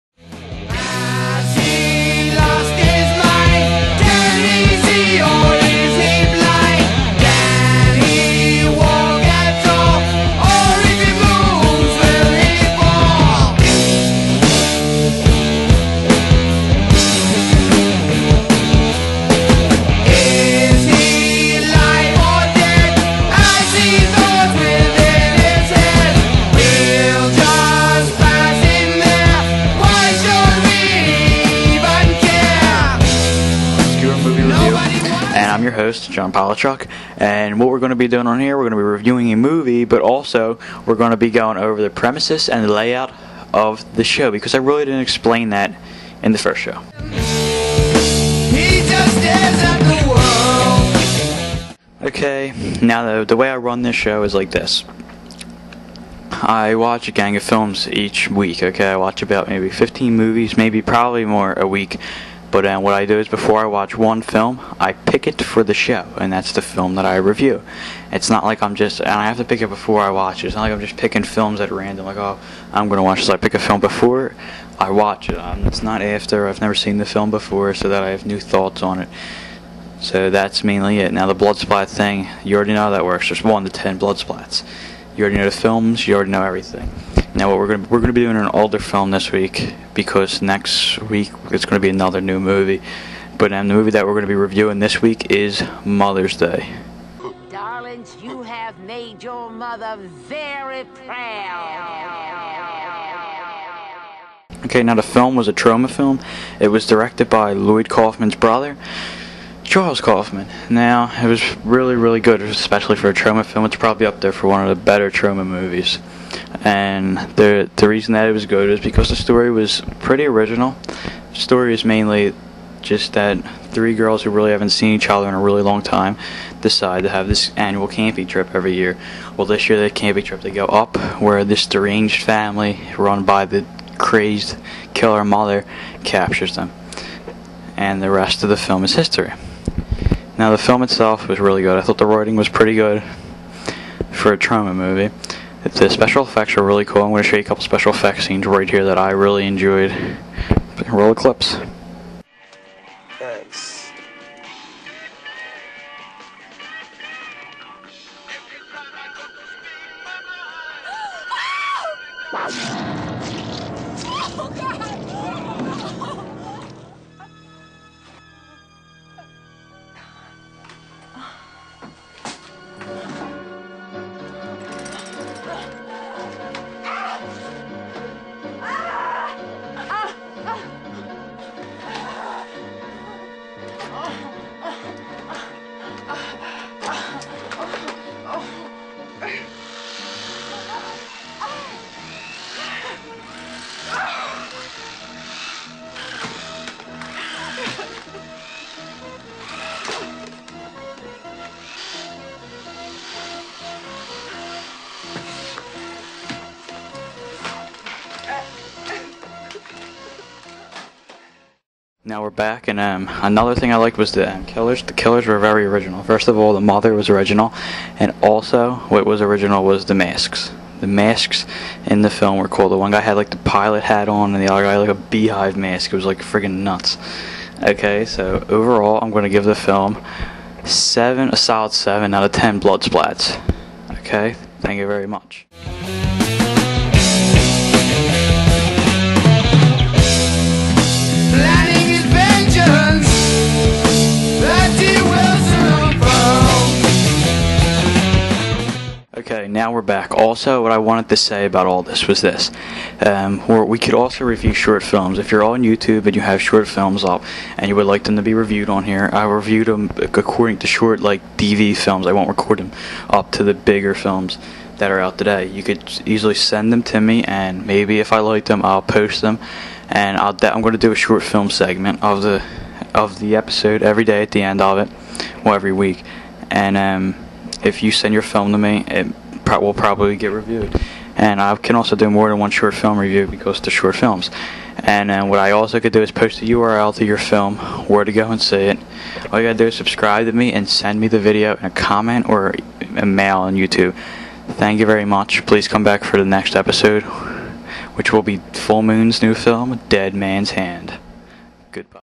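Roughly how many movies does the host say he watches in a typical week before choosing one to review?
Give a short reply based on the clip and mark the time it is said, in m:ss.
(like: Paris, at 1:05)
15, at 0:59.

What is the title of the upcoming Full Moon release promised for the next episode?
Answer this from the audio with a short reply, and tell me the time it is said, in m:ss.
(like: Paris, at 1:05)
Dead Man's Hand, at 4:59.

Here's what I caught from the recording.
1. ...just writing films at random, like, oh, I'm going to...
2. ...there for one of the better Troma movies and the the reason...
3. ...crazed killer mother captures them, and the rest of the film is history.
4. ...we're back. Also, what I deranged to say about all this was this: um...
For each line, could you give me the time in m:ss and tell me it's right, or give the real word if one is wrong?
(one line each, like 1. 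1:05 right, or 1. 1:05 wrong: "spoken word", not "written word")
1. 1:10 wrong: "picking", not "writing"
2. 1:54 right
3. 2:13 right
4. 4:09 wrong: "wanted", not "deranged".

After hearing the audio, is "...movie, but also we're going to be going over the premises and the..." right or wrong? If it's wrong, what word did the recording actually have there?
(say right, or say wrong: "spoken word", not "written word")
right.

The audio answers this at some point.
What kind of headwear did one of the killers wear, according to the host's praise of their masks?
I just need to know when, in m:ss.
3:43.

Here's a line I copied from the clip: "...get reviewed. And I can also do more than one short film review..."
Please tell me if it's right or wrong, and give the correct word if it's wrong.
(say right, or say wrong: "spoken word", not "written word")
right.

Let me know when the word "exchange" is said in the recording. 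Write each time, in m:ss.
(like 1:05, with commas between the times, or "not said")
not said.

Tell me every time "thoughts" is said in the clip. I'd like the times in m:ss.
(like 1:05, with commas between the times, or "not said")
1:18, 2:21.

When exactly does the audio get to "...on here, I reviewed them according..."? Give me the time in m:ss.
4:18.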